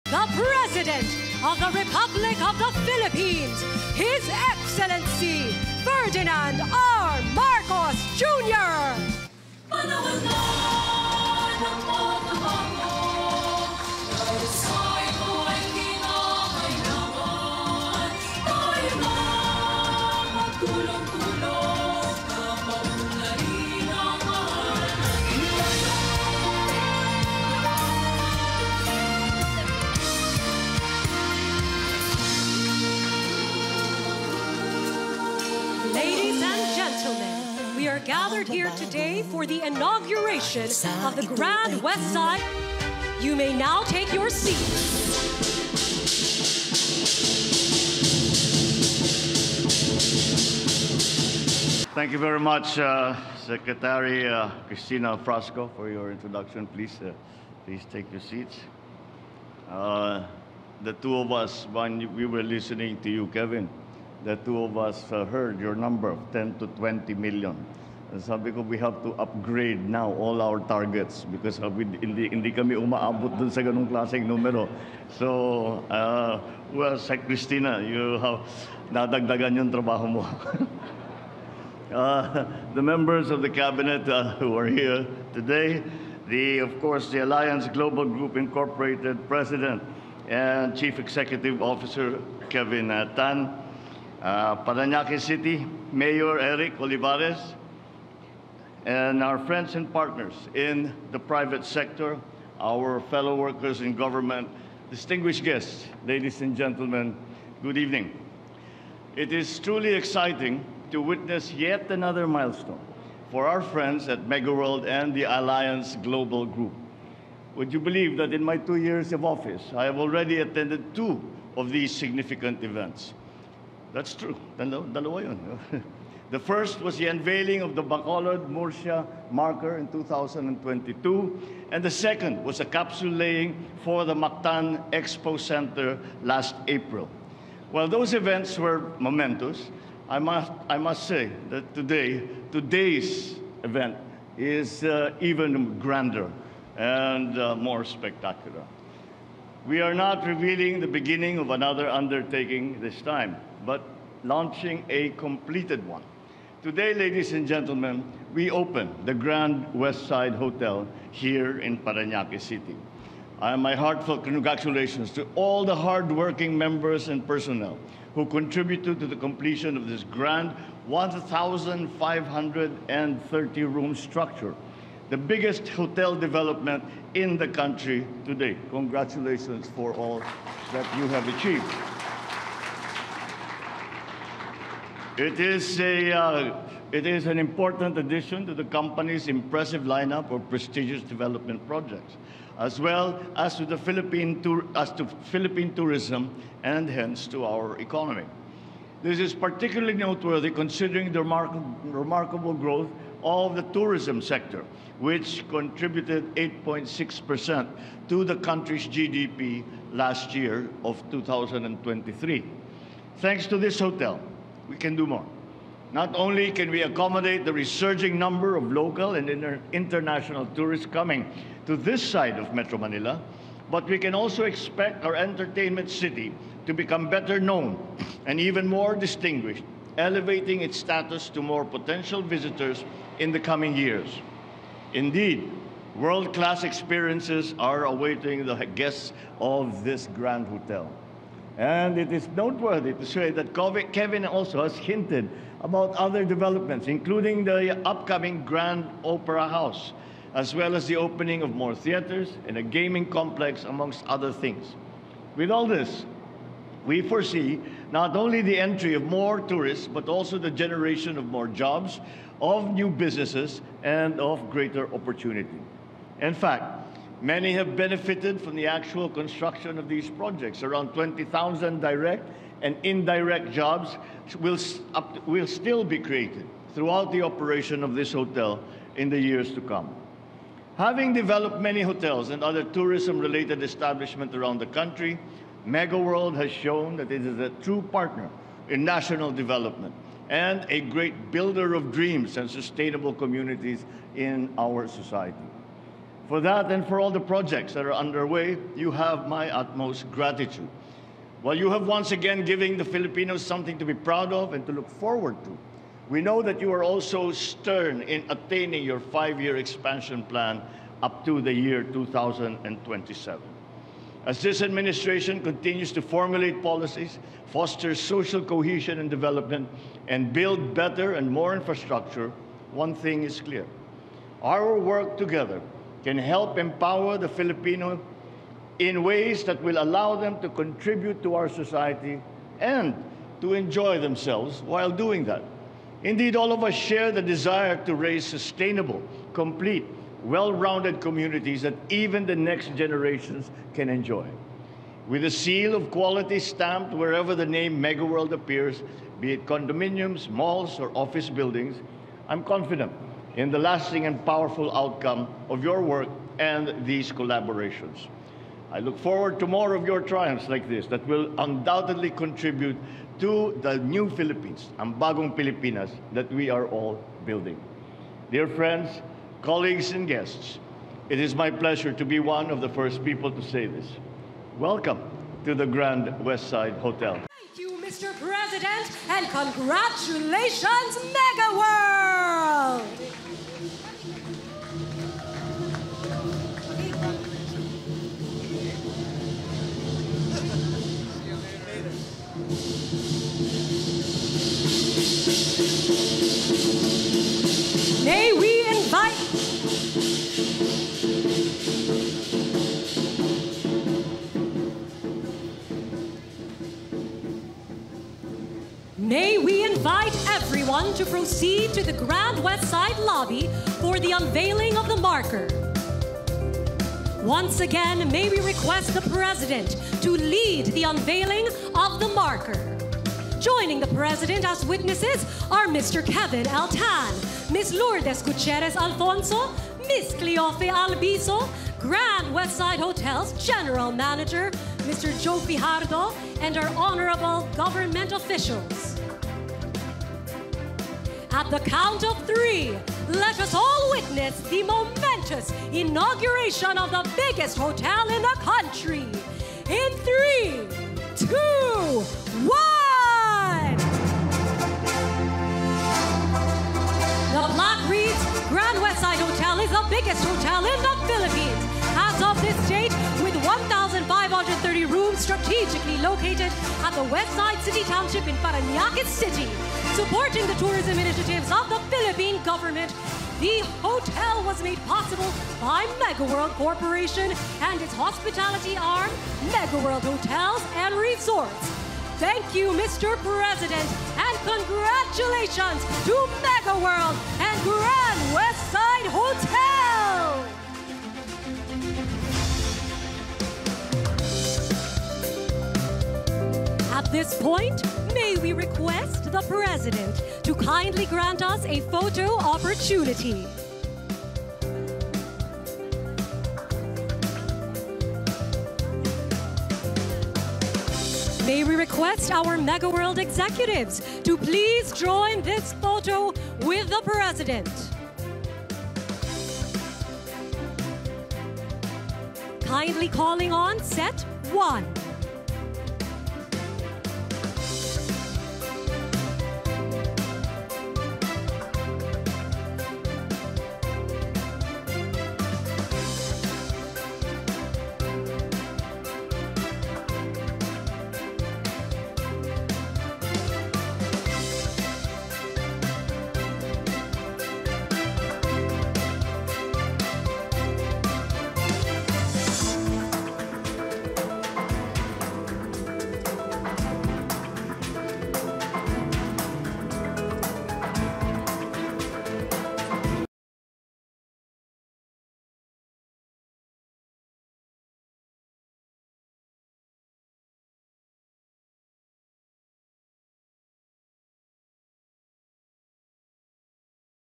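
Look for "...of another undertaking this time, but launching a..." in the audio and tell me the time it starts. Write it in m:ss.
2:31.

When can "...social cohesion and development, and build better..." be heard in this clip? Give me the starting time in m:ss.
5:17.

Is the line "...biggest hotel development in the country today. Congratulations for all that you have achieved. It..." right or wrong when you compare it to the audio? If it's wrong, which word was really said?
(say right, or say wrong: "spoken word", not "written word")
right.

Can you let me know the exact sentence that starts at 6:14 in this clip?
Welcome to the Grand Westside Hotel.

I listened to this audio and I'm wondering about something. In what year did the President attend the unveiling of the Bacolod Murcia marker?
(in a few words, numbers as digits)
2022.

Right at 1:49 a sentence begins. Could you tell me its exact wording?
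It is truly exciting to witness yet another milestone for our friends at MegaWorld and the Alliance Global Group.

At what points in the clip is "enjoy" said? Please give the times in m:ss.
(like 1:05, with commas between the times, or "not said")
5:33, 5:43.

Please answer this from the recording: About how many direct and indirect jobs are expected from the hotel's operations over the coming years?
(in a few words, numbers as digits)
20,000.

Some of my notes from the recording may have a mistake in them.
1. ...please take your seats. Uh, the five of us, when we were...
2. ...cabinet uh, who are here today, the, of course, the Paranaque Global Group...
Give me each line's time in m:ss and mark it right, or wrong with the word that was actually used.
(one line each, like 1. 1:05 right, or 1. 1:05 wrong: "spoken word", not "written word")
1. 0:57 wrong: "two", not "five"
2. 1:23 wrong: "Alliance", not "Paranaque".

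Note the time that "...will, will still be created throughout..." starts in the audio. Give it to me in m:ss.
4:34.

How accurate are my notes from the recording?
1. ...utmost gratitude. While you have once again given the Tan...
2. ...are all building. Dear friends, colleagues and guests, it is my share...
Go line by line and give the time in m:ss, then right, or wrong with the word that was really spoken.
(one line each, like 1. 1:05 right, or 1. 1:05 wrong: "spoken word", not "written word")
1. 4:59 wrong: "Filipinos", not "Tan"
2. 6:06 wrong: "pleasure", not "share".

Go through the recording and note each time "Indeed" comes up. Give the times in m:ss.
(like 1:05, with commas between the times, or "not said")
3:54, 5:36.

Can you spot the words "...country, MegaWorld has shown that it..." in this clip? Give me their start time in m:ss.
4:44.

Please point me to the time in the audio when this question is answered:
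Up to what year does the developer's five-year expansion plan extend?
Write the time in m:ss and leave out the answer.
5:11.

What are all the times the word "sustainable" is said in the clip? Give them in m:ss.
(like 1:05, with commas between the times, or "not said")
4:52, 5:38.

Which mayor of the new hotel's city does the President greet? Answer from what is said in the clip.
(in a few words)
Eric Olivares.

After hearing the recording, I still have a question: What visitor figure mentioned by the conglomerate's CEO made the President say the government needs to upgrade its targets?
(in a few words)
10 to 20 million.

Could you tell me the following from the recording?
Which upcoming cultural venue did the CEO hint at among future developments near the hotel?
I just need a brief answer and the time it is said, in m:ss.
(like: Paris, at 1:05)
Grand Opera House, at 4:08.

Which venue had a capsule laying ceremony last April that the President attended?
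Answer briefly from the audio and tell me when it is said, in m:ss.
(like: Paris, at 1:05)
Mactan Expo Center, at 2:14.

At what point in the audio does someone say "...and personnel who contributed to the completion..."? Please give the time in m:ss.
2:47.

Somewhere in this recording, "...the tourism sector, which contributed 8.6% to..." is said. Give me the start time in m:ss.
3:23.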